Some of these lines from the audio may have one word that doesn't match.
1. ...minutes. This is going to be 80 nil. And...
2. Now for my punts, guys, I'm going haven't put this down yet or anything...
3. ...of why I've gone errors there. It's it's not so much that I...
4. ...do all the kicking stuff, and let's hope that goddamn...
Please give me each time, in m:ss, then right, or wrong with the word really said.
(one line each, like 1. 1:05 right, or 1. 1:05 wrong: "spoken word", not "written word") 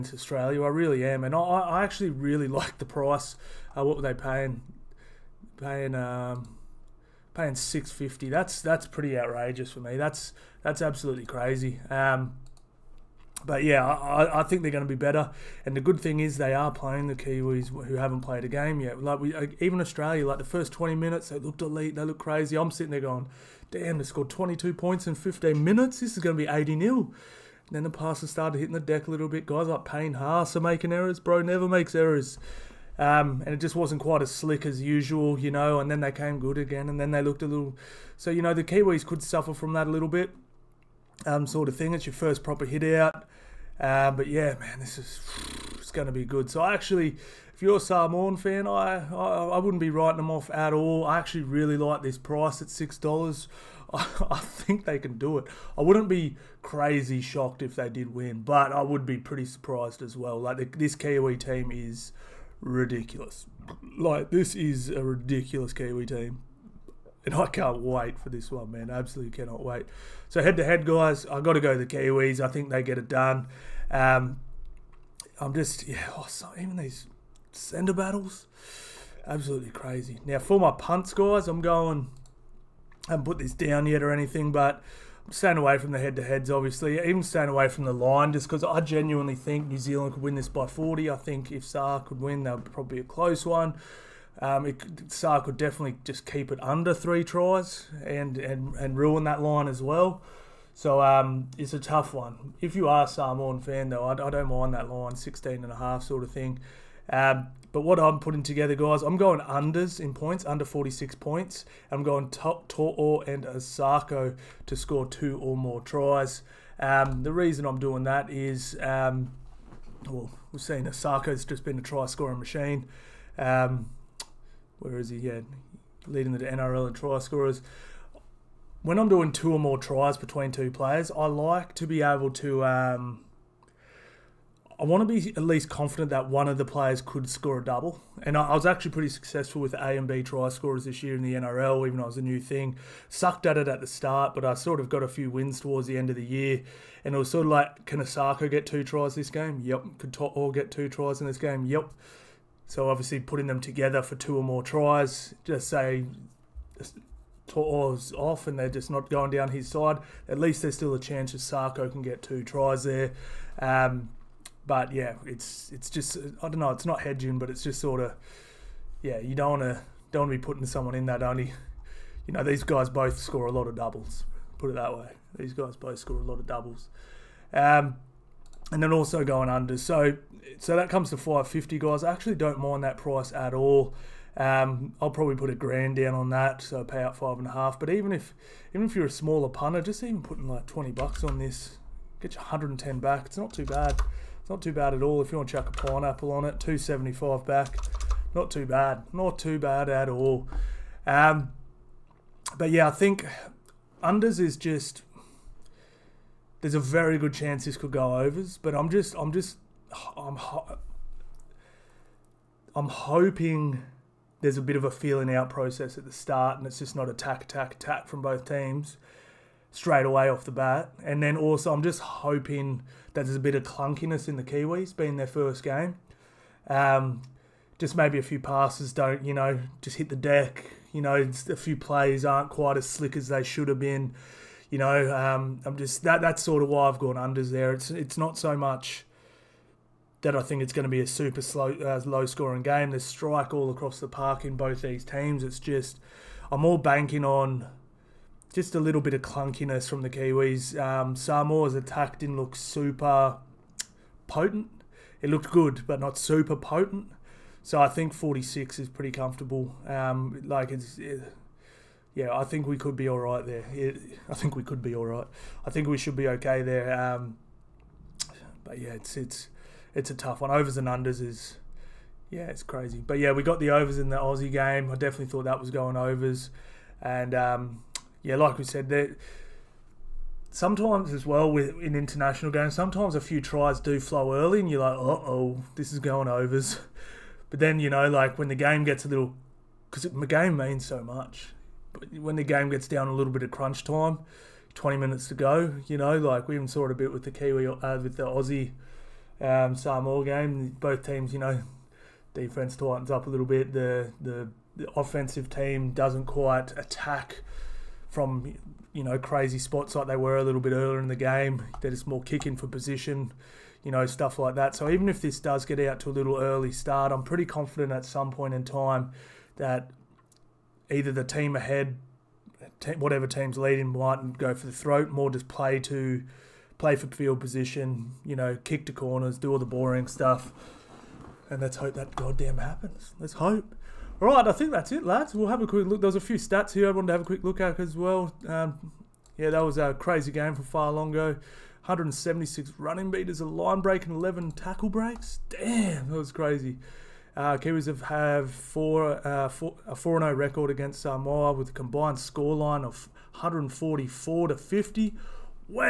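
1. 0:25 right
2. 1:20 right
3. 3:56 wrong: "unders", not "errors"
4. 5:29 wrong: "boring", not "kicking".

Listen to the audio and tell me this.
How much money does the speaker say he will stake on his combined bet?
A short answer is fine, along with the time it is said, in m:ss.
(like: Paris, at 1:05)
a grand, at 3:05.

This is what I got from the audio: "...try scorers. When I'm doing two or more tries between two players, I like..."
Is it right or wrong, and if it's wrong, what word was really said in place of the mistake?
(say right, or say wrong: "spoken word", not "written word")
right.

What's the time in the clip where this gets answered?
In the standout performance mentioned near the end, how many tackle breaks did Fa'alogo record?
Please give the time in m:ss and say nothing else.
5:44.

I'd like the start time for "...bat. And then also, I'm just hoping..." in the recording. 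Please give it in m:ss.
3:40.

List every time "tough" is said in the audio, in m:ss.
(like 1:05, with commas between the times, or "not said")
1:41, 4:30.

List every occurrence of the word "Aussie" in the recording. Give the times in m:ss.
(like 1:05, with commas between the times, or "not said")
4:34, 4:58.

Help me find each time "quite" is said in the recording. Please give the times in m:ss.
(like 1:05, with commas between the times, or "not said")
0:34, 3:52, 5:06.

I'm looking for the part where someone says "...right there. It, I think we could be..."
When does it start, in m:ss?
4:23.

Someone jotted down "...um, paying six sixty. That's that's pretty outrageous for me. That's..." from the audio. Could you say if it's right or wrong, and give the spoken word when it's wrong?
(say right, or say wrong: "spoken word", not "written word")
wrong: "fifty", not "sixty".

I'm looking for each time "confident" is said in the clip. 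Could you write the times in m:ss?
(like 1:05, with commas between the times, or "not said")
2:15, 5:17.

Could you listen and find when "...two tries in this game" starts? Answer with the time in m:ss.
2:30.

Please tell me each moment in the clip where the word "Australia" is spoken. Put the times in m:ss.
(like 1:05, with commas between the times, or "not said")
0:00, 0:19.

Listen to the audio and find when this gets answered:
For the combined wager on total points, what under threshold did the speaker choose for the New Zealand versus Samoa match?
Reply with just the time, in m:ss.
1:50.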